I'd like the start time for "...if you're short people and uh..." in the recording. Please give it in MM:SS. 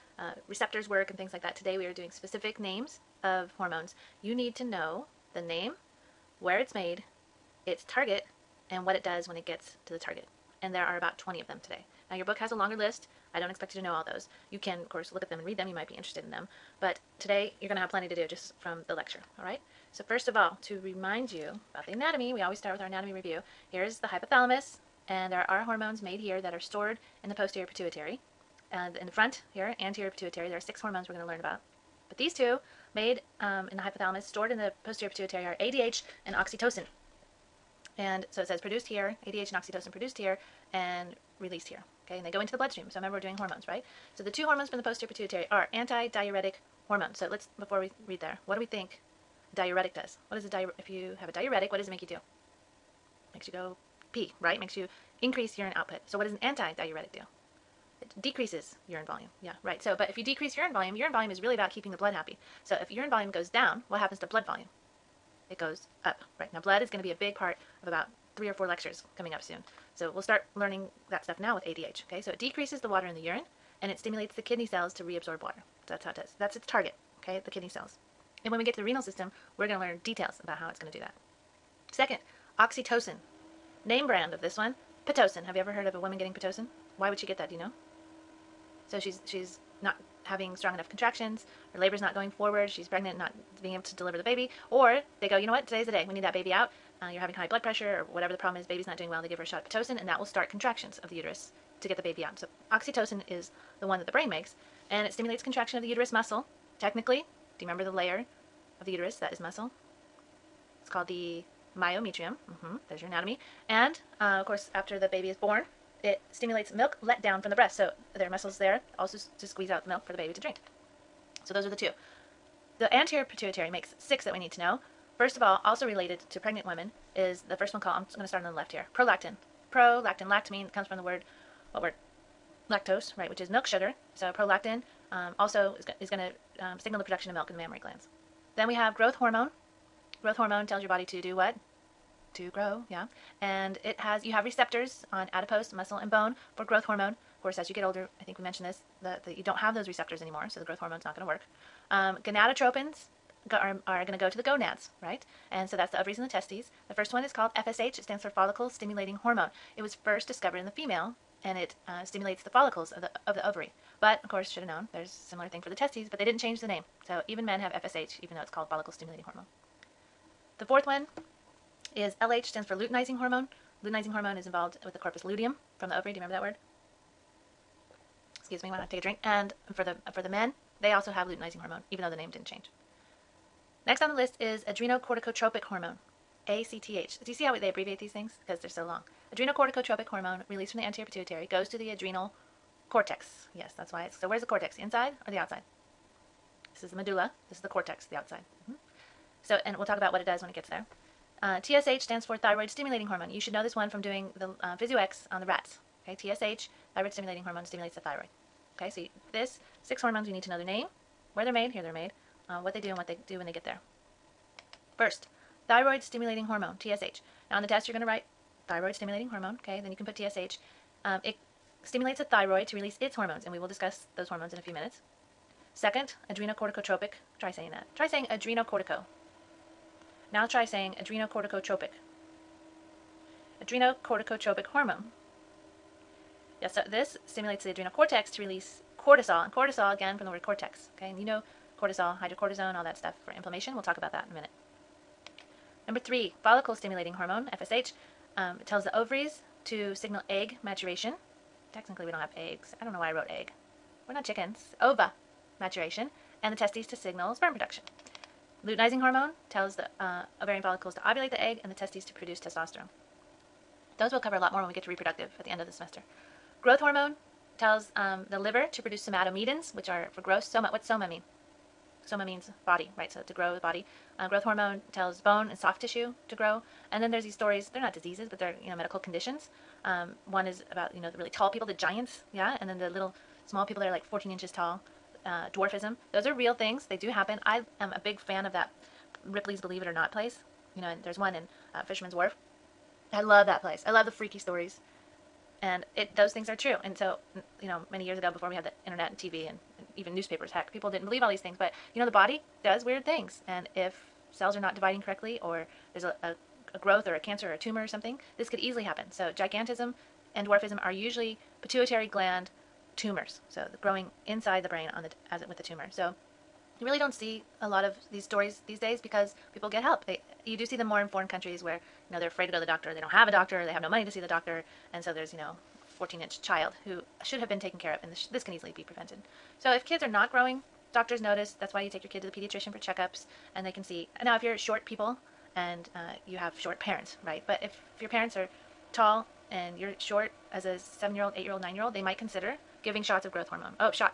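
05:34.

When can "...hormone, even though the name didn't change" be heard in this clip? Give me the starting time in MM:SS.
03:01.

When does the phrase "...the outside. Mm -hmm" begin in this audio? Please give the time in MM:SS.
03:18.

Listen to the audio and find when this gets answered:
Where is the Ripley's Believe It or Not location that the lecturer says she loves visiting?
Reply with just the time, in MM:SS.
04:51.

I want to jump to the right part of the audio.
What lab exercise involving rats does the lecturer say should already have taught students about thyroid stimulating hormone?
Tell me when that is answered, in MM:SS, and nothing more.
03:24.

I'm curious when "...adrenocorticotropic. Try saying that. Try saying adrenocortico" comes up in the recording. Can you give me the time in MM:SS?
03:46.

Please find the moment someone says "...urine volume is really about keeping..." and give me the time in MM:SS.
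01:00.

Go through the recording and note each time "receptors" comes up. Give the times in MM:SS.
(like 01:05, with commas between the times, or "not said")
00:00, 02:24, 02:29.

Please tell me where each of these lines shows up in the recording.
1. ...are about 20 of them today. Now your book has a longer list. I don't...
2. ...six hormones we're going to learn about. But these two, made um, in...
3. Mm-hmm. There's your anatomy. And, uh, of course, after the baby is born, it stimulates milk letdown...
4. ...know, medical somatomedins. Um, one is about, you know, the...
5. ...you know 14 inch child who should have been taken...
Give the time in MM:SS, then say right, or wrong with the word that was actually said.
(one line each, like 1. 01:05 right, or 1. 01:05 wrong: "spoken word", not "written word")
1. 00:10 right
2. 00:30 right
3. 01:52 right
4. 04:38 wrong: "conditions", not "somatomedins"
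5. 05:25 right.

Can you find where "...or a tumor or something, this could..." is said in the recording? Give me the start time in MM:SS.
05:07.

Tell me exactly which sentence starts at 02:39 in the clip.
It was first discovered in the female and it uh, stimulates the follicles of the, of the ovary.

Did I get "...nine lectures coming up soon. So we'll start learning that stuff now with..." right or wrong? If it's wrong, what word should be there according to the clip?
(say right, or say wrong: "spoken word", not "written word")
wrong: "four", not "nine".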